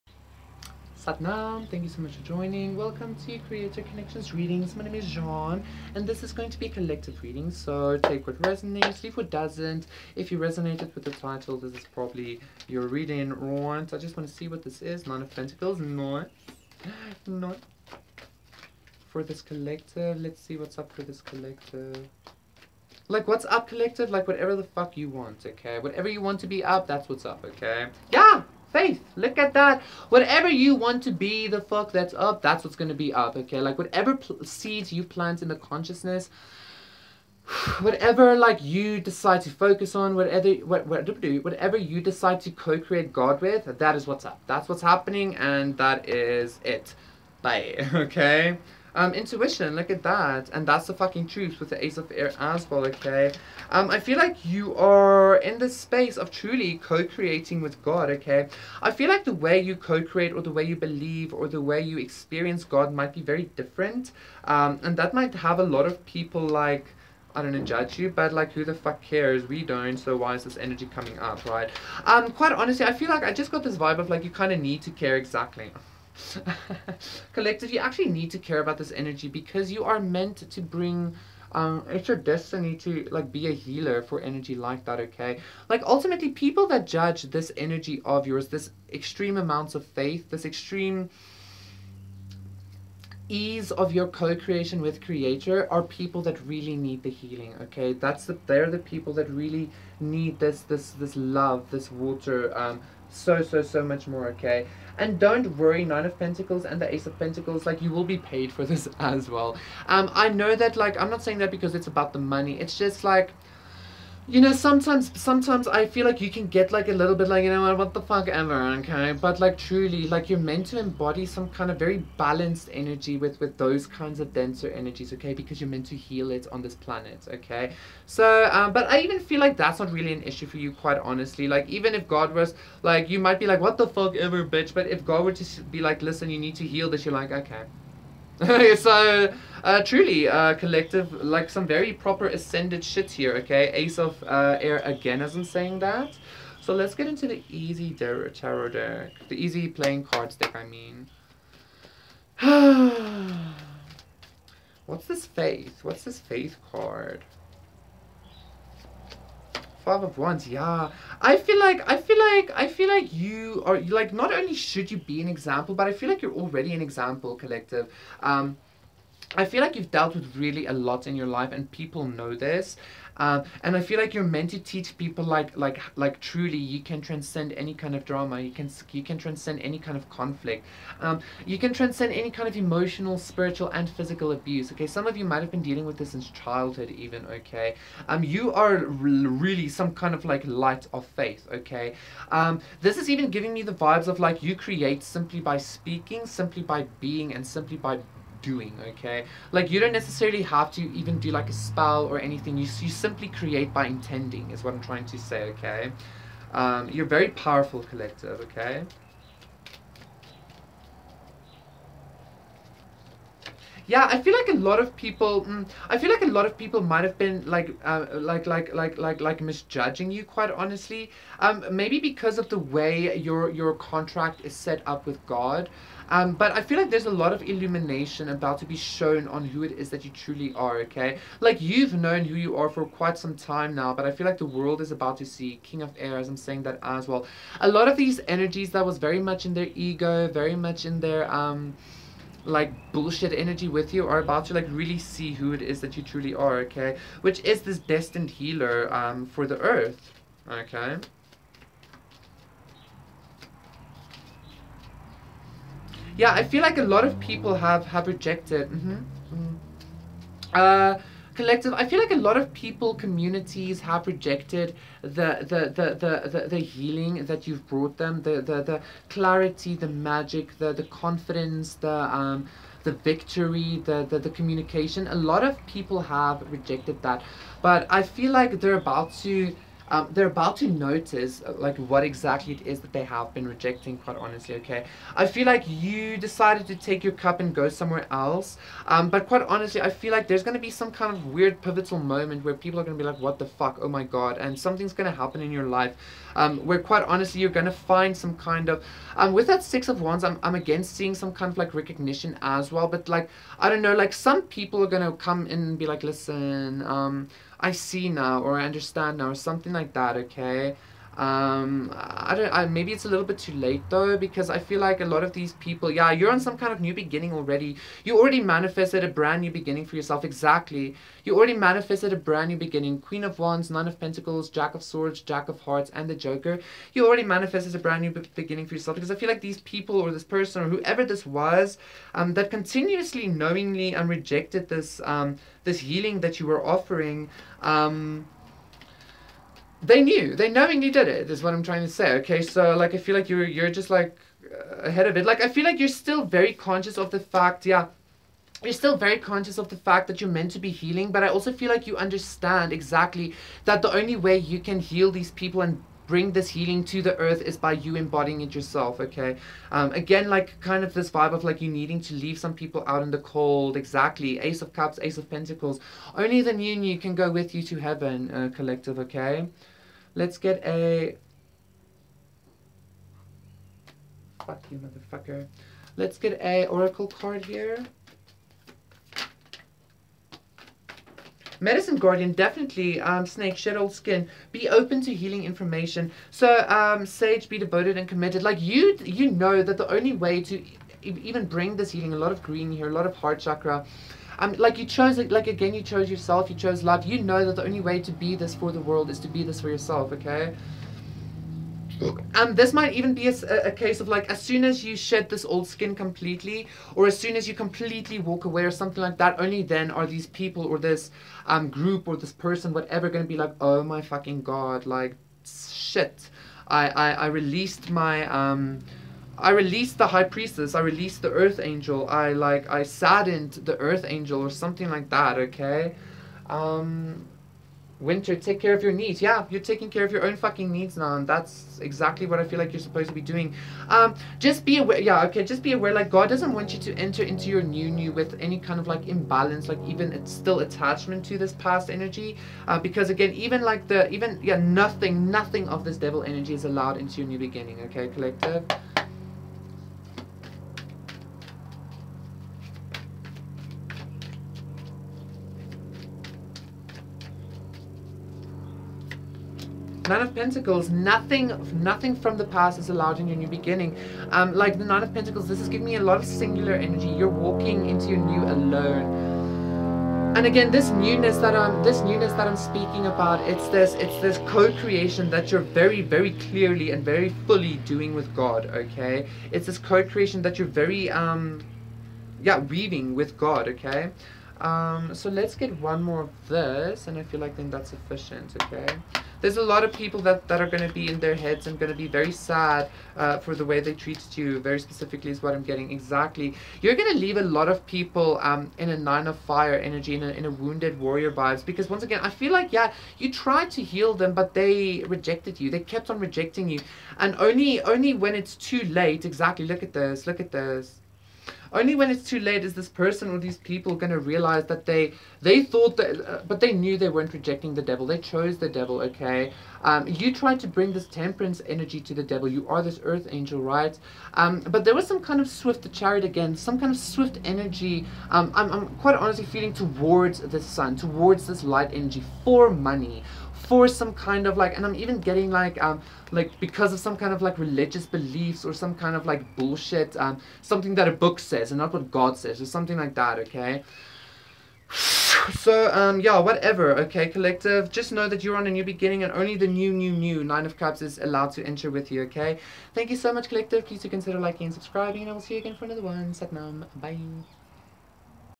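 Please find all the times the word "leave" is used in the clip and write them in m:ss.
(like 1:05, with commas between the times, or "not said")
0:09, 6:02, 8:17.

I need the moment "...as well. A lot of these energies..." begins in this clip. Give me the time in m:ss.
3:56.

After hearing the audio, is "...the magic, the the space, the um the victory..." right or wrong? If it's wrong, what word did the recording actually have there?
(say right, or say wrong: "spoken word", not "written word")
wrong: "confidence", not "space".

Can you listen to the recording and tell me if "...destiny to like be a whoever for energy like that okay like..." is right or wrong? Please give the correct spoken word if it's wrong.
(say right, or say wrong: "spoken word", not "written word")
wrong: "healer", not "whoever".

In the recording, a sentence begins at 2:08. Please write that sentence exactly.
So, um, but I even feel like that's not really an issue for you, quite honestly.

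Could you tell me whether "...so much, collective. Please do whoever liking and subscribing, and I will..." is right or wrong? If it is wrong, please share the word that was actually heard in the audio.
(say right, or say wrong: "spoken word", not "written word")
wrong: "consider", not "whoever".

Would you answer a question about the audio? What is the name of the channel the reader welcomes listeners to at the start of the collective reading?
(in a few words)
Creator Connections Readings.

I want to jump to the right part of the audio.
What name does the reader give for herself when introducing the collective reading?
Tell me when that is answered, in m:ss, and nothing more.
0:05.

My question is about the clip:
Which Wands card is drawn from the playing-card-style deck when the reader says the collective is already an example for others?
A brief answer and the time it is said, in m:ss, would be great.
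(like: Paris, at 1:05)
Five of Wands, at 2:39.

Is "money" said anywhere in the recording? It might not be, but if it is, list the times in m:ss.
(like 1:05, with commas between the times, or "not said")
1:52, 8:52.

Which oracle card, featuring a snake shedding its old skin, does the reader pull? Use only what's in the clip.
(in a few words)
Medicine Guardian.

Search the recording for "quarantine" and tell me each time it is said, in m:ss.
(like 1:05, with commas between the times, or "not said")
not said.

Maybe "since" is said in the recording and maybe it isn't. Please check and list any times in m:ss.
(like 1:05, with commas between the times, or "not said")
3:06.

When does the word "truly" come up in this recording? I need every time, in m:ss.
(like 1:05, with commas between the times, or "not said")
0:56, 1:59, 2:19, 2:56, 3:50, 4:06.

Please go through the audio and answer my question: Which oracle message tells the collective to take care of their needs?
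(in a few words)
Winter.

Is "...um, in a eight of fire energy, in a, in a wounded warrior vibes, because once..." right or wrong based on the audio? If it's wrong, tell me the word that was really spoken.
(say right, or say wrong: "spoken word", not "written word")
wrong: "nine", not "eight".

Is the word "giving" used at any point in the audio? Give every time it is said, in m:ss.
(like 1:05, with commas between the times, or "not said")
3:13, 7:45.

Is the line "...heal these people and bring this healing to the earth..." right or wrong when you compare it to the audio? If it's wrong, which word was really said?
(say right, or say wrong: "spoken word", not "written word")
right.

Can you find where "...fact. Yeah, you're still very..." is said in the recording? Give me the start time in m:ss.
5:47.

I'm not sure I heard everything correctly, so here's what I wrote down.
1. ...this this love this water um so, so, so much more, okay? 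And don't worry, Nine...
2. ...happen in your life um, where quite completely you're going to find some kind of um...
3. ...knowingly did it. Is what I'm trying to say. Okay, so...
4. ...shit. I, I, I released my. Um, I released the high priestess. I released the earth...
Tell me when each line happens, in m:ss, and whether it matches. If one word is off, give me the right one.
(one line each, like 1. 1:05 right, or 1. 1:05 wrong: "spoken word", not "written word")
1. 1:40 right
2. 4:55 wrong: "honestly", not "completely"
3. 5:40 right
4. 6:55 right.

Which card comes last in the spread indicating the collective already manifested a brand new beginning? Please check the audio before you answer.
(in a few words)
The Joker.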